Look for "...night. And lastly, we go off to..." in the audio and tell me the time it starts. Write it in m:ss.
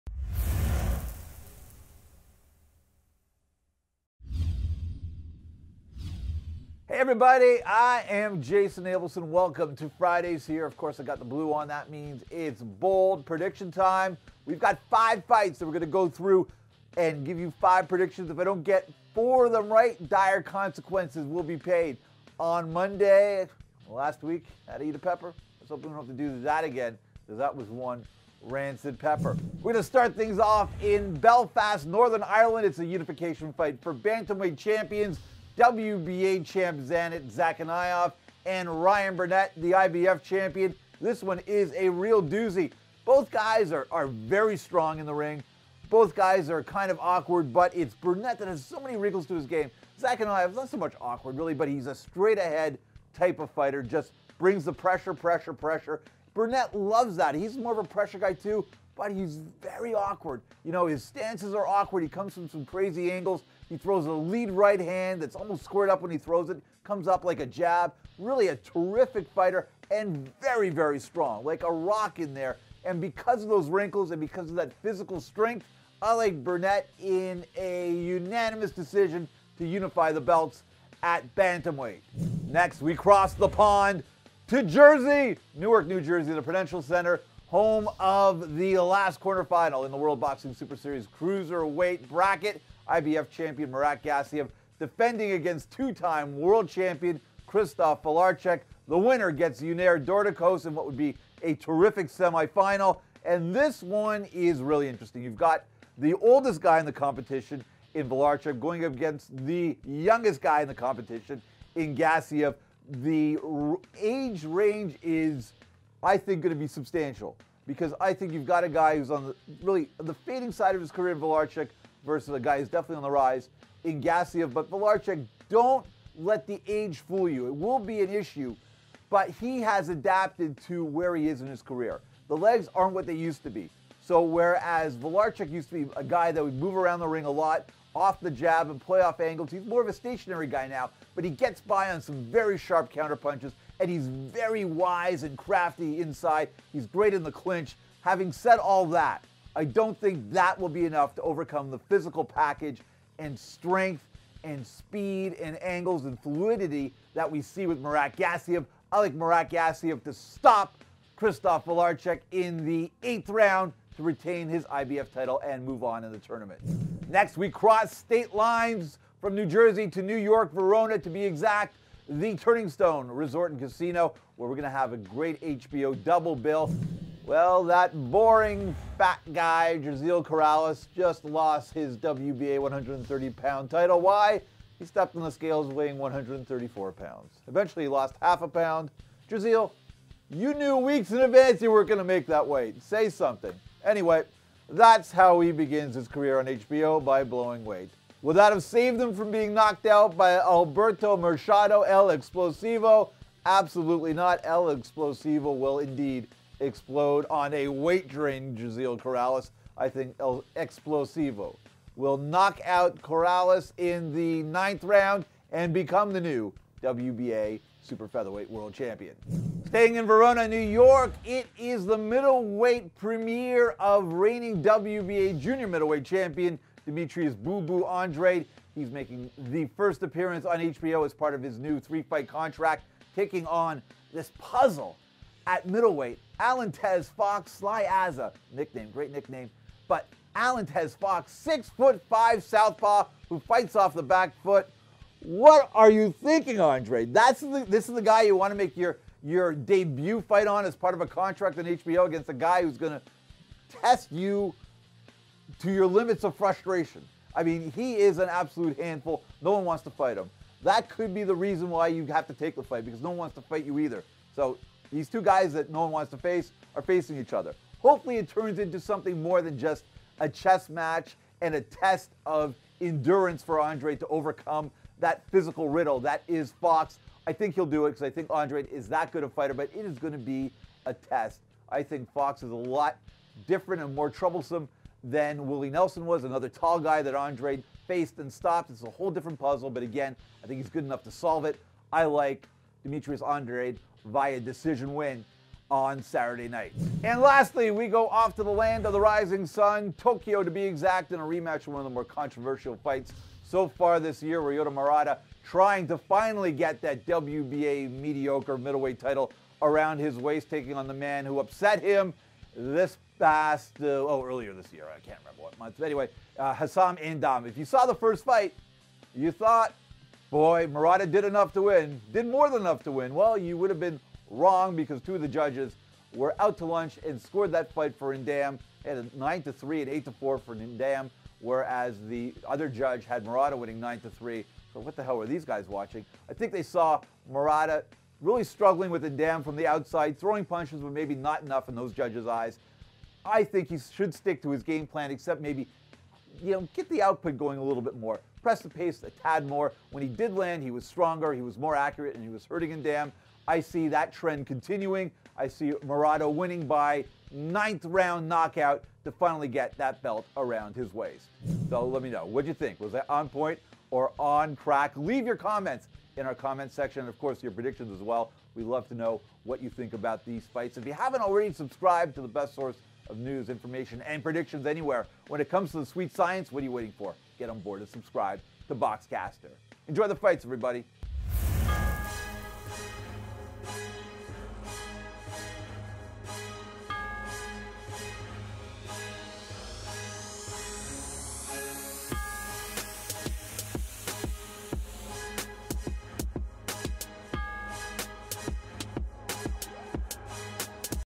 4:56.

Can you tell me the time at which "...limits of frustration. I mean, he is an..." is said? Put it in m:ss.
4:15.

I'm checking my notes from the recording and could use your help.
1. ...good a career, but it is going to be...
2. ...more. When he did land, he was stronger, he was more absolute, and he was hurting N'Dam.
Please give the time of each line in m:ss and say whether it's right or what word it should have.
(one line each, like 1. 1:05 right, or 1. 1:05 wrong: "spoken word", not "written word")
1. 4:39 wrong: "fighter", not "career"
2. 5:49 wrong: "accurate", not "absolute".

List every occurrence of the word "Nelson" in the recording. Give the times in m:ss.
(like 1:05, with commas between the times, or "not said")
4:45.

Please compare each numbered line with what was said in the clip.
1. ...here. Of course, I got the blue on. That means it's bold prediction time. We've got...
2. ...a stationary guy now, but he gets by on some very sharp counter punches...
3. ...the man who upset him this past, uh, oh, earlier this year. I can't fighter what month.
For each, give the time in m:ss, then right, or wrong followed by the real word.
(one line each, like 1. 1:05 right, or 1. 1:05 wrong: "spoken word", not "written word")
1. 0:10 right
2. 2:19 right
3. 5:10 wrong: "remember", not "fighter".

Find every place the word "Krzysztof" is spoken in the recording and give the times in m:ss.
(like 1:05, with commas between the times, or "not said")
1:37, 2:41.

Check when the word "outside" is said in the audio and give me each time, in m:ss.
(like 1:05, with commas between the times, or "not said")
5:39.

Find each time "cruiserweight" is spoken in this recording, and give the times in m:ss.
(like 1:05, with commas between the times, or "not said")
1:31.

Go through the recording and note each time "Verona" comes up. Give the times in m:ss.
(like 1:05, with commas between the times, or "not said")
2:50, 3:40.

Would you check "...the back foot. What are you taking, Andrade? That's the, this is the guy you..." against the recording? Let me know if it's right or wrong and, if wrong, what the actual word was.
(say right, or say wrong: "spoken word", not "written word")
wrong: "thinking", not "taking".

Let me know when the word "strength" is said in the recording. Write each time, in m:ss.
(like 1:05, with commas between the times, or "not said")
1:15, 2:33.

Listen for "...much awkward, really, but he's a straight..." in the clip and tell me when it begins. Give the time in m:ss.
0:50.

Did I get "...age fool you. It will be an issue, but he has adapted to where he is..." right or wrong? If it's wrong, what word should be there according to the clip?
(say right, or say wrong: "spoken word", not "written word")
right.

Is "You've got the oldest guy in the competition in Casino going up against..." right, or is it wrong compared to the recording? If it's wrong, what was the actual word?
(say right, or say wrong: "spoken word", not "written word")
wrong: "Wlodarczyk", not "Casino".